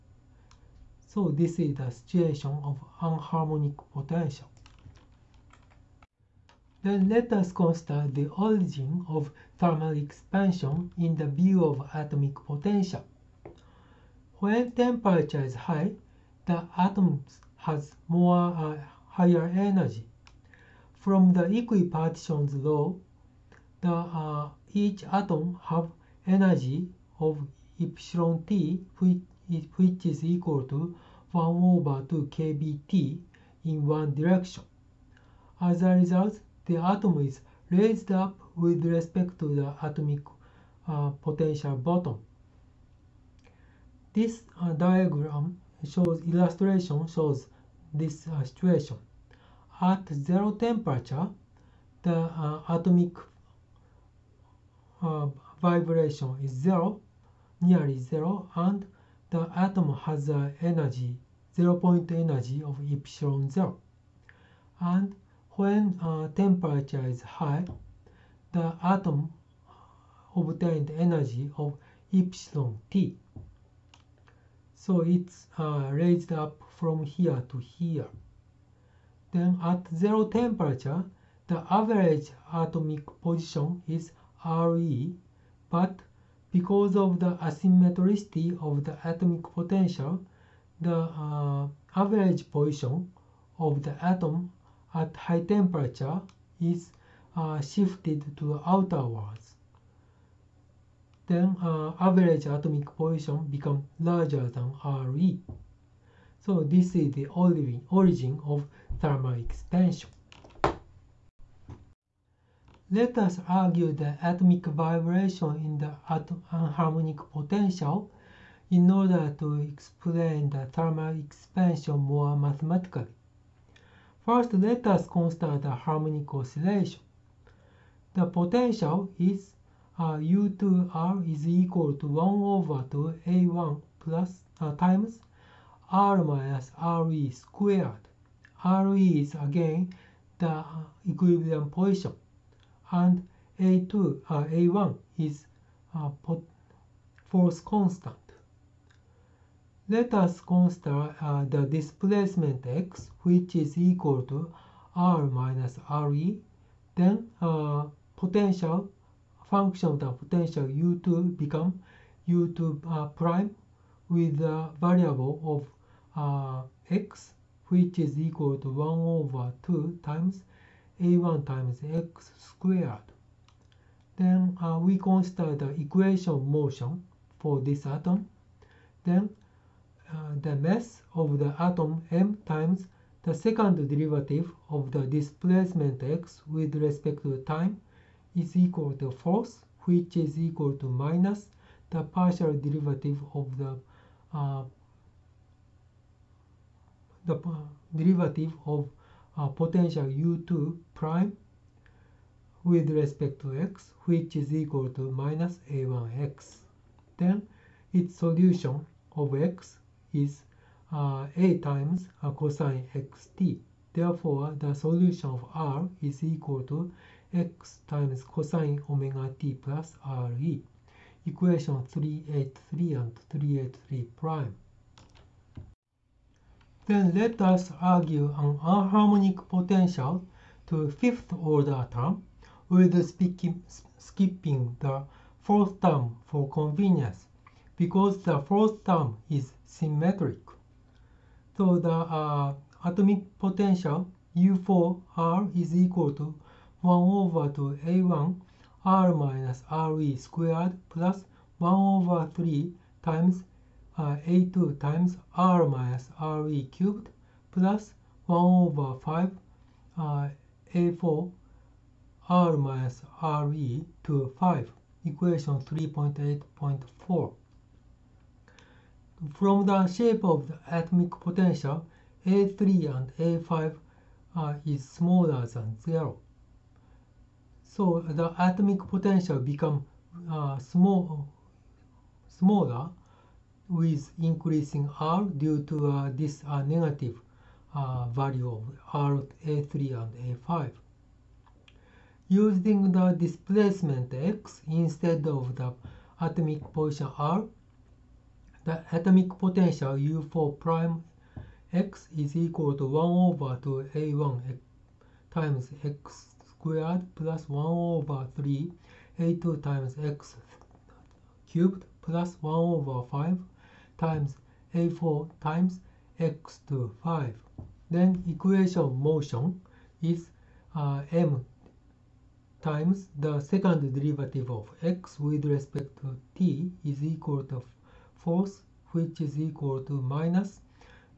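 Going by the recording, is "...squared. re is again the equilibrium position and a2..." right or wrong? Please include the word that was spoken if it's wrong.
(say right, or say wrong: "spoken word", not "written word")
right.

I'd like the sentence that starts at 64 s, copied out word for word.
And when uh, temperature is high, the atom obtained energy of epsilon t.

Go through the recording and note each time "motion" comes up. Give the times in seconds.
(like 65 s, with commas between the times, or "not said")
176 s, 319 s.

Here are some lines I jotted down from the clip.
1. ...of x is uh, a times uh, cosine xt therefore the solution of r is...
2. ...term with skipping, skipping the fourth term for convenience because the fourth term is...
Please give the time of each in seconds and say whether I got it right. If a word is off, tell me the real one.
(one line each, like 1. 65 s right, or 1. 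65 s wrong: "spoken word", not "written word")
1. 209 s right
2. 231 s wrong: "speaking", not "skipping".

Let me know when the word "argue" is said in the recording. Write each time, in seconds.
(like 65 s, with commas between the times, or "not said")
113 s, 227 s.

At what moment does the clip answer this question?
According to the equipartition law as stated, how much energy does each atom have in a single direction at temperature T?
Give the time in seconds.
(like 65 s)
31 s.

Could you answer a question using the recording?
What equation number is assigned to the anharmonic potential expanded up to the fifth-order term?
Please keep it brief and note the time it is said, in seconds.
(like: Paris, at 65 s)
3.8.4, at 265 s.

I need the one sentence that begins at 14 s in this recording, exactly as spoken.
When temperature is high, the atoms has more uh, higher energy.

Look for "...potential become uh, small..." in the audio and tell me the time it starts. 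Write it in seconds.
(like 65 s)
278 s.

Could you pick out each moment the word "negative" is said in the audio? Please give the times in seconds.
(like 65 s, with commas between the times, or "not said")
286 s.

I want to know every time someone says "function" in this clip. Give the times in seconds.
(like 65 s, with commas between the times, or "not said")
159 s.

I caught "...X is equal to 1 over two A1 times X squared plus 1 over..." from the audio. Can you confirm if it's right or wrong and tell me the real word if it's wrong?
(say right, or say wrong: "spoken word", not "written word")
right.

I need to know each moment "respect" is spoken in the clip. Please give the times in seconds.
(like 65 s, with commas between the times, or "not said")
38 s, 186 s, 202 s, 325 s.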